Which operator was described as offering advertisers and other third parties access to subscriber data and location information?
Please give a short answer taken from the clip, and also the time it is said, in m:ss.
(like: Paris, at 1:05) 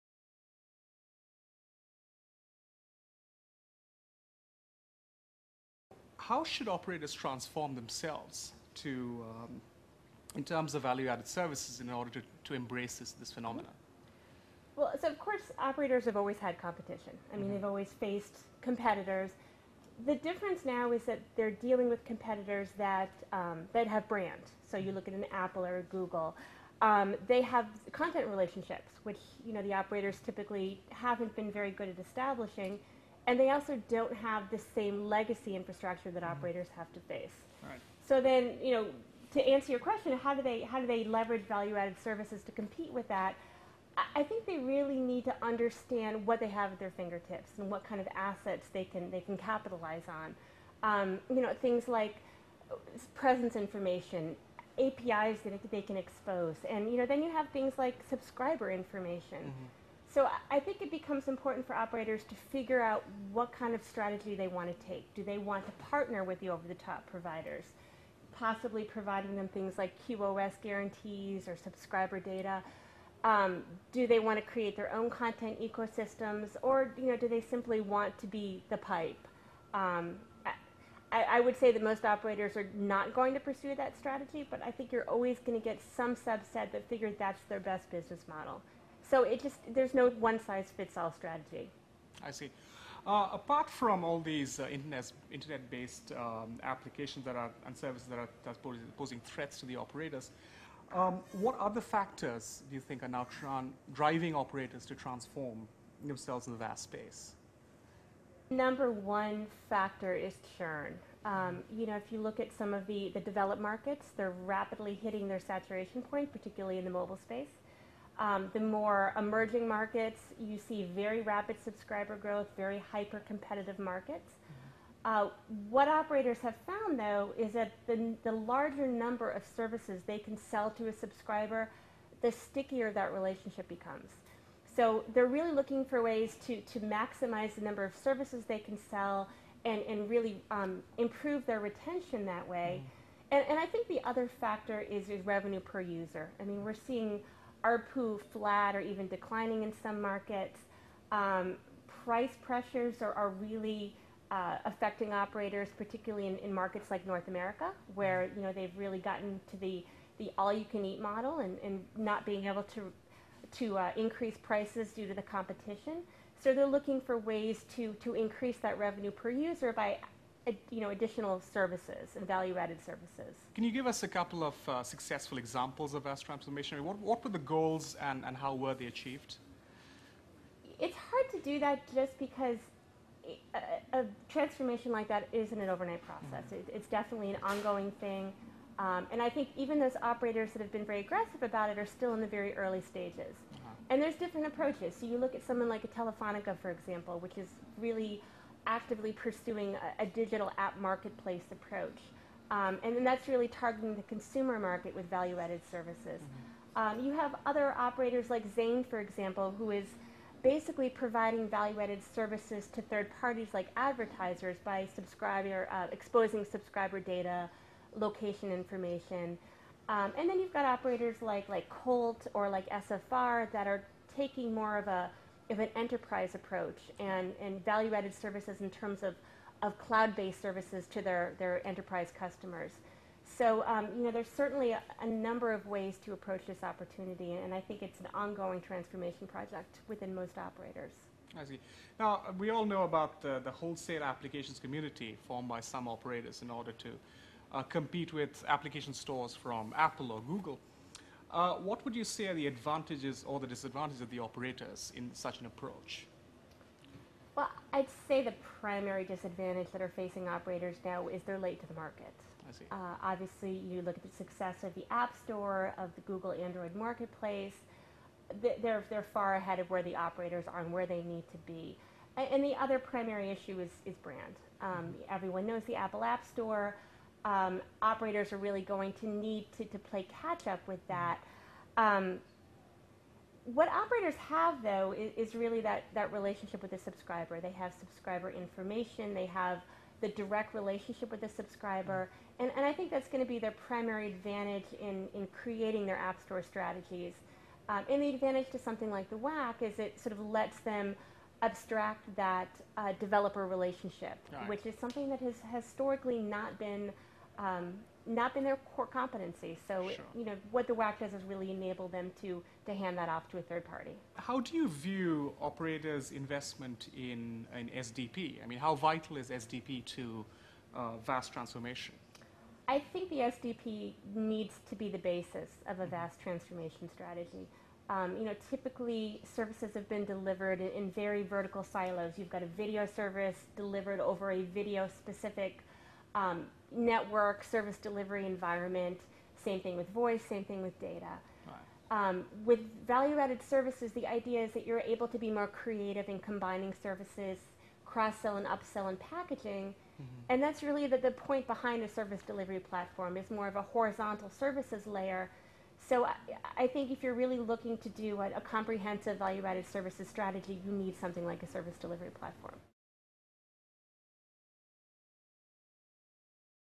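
Zain, at 3:28.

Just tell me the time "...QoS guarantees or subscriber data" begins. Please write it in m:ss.
1:10.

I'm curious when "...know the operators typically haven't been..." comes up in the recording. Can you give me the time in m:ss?
0:29.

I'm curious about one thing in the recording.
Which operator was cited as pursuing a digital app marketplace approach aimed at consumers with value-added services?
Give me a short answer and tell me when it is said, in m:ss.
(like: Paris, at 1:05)
Telefonica, at 3:15.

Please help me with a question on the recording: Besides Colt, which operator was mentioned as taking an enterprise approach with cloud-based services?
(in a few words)
SFR.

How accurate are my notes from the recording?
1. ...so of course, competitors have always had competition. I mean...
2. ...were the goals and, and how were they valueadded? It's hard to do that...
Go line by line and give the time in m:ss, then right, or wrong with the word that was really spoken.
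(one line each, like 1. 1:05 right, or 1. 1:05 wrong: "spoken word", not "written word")
1. 0:15 wrong: "operators", not "competitors"
2. 2:57 wrong: "achieved", not "valueadded".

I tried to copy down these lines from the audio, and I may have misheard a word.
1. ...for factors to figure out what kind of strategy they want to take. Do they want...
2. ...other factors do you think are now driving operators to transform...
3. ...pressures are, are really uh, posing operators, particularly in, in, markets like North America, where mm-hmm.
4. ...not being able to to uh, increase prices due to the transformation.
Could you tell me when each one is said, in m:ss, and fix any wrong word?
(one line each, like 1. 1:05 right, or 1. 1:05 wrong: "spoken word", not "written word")
1. 1:01 wrong: "operators", not "factors"
2. 1:41 right
3. 2:32 wrong: "affecting", not "posing"
4. 2:41 wrong: "competition", not "transformation".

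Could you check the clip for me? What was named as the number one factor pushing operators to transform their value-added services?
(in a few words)
Churn.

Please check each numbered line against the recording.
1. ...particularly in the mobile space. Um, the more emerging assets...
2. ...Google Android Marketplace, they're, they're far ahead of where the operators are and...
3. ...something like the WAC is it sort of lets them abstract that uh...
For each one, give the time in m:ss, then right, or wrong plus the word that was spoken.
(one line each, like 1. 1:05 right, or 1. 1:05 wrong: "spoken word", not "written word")
1. 1:56 wrong: "markets", not "assets"
2. 4:26 right
3. 4:58 right.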